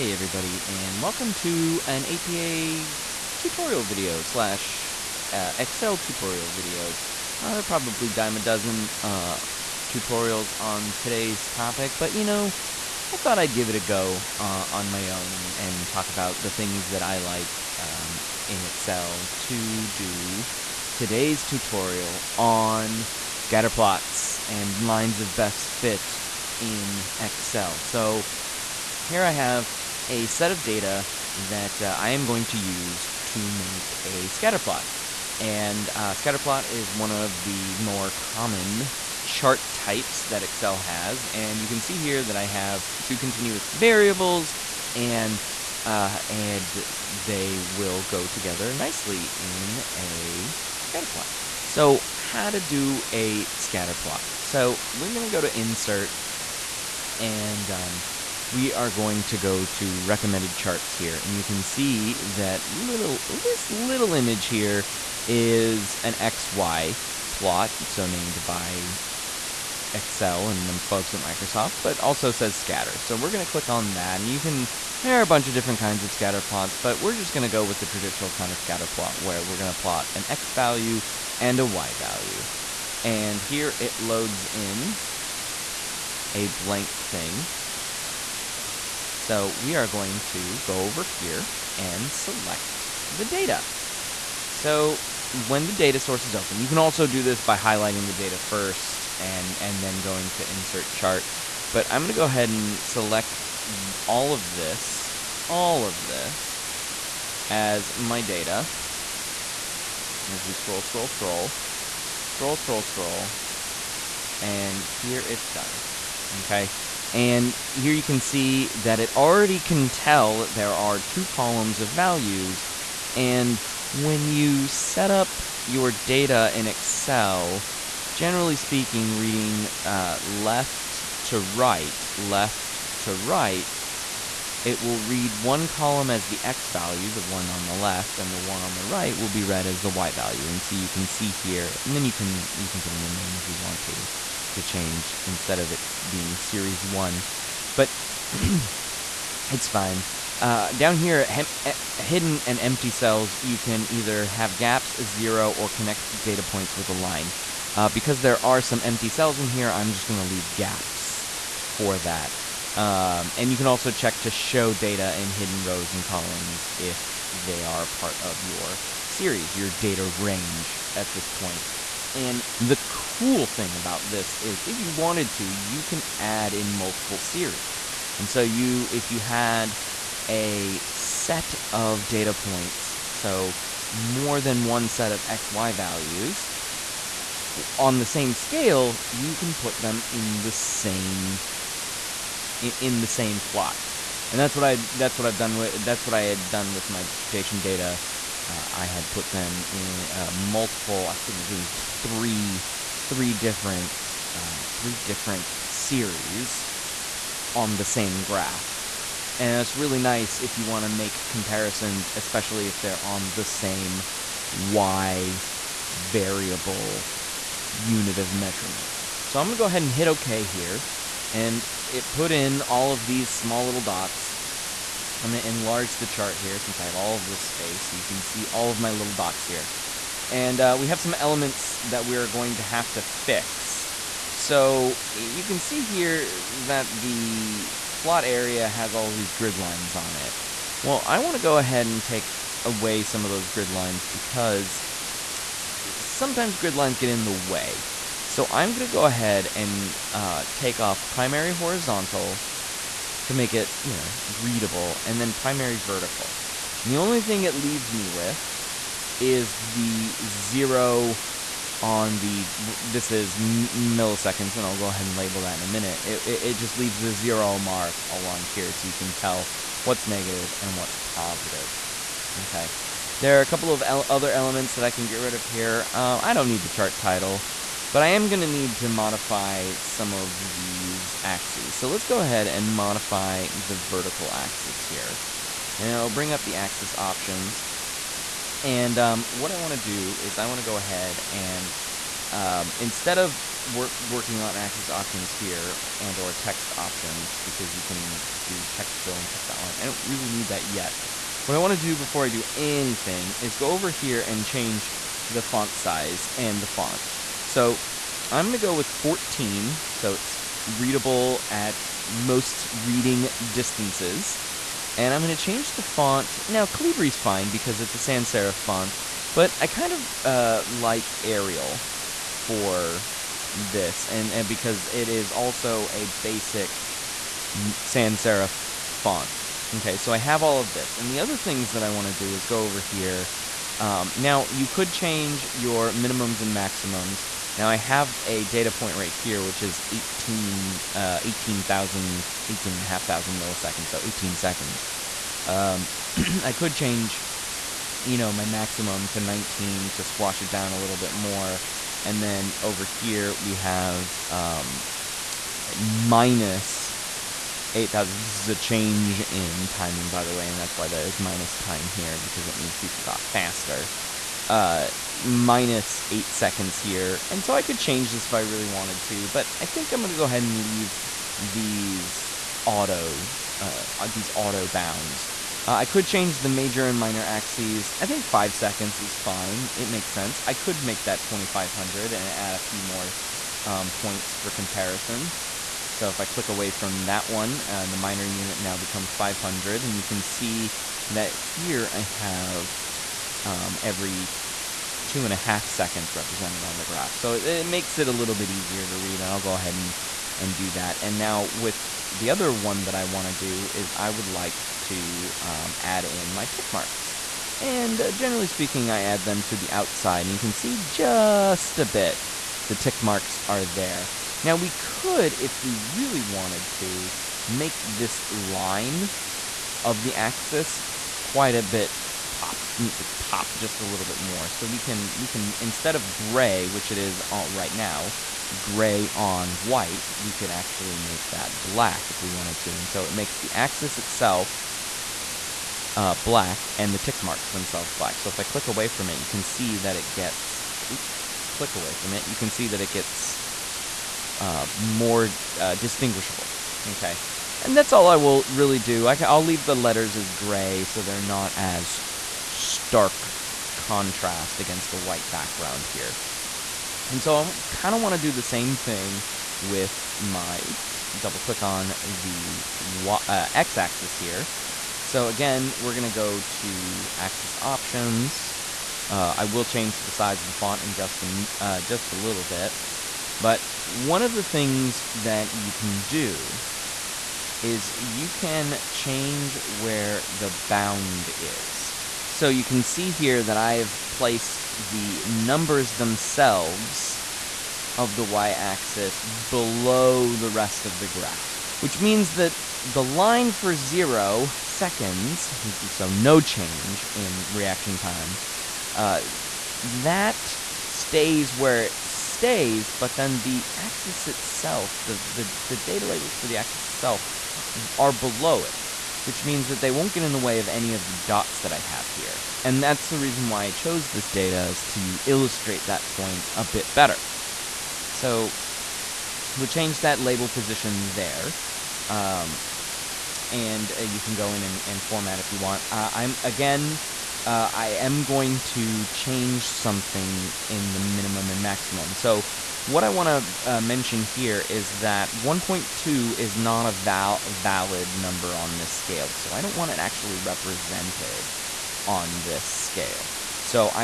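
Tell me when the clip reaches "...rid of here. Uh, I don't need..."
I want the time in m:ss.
4:35.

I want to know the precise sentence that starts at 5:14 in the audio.
And I'm going to change the font.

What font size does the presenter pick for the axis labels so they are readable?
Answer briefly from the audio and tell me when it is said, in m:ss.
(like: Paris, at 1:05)
14, at 5:08.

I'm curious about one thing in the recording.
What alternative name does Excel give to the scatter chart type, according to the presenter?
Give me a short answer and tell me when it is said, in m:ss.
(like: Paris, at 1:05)
XY plot, at 1:06.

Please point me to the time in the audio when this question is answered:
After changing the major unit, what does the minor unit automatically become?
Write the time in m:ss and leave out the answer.
6:29.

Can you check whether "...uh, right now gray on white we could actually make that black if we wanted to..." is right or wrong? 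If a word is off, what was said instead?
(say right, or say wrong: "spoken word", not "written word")
right.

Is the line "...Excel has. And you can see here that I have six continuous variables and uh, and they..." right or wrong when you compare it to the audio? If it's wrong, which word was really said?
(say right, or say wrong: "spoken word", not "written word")
wrong: "two", not "six".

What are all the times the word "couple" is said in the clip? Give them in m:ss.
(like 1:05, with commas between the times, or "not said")
4:33.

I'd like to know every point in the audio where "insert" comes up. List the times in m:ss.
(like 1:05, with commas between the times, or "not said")
0:55, 1:40.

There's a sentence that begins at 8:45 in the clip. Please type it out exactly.
Uh, I'm again uh, I am going to change something in the minimum and maximum.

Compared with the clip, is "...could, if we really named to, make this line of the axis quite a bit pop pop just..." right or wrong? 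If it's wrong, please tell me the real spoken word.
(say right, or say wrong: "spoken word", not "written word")
wrong: "wanted", not "named".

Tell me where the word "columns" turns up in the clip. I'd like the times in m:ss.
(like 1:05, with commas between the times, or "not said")
2:01, 2:15, 2:46.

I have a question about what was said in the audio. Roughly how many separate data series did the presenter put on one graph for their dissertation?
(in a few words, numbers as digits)
3.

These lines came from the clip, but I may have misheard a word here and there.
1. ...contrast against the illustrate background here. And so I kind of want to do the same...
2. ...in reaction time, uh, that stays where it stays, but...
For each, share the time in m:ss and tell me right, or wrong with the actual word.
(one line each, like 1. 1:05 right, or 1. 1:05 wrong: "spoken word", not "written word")
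1. 7:33 wrong: "white", not "illustrate"
2. 8:17 right.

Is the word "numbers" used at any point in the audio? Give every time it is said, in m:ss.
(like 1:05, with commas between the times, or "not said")
8:05, 8:58.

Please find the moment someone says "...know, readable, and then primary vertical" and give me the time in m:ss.
4:13.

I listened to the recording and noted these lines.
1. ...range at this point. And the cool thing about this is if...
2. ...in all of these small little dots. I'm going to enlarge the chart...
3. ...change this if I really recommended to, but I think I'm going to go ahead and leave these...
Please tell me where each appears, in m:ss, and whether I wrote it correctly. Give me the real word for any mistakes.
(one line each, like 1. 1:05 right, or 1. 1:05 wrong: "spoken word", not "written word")
1. 2:50 right
2. 3:42 right
3. 6:07 wrong: "wanted", not "recommended".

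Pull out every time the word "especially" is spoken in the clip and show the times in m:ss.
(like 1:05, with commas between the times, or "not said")
3:32.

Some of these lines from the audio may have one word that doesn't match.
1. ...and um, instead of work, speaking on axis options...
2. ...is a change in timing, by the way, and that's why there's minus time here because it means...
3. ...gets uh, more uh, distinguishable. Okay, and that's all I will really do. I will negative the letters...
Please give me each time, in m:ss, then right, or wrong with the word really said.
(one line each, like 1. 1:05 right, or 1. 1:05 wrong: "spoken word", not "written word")
1. 4:51 wrong: "working", not "speaking"
2. 5:58 right
3. 7:22 wrong: "leave", not "negative".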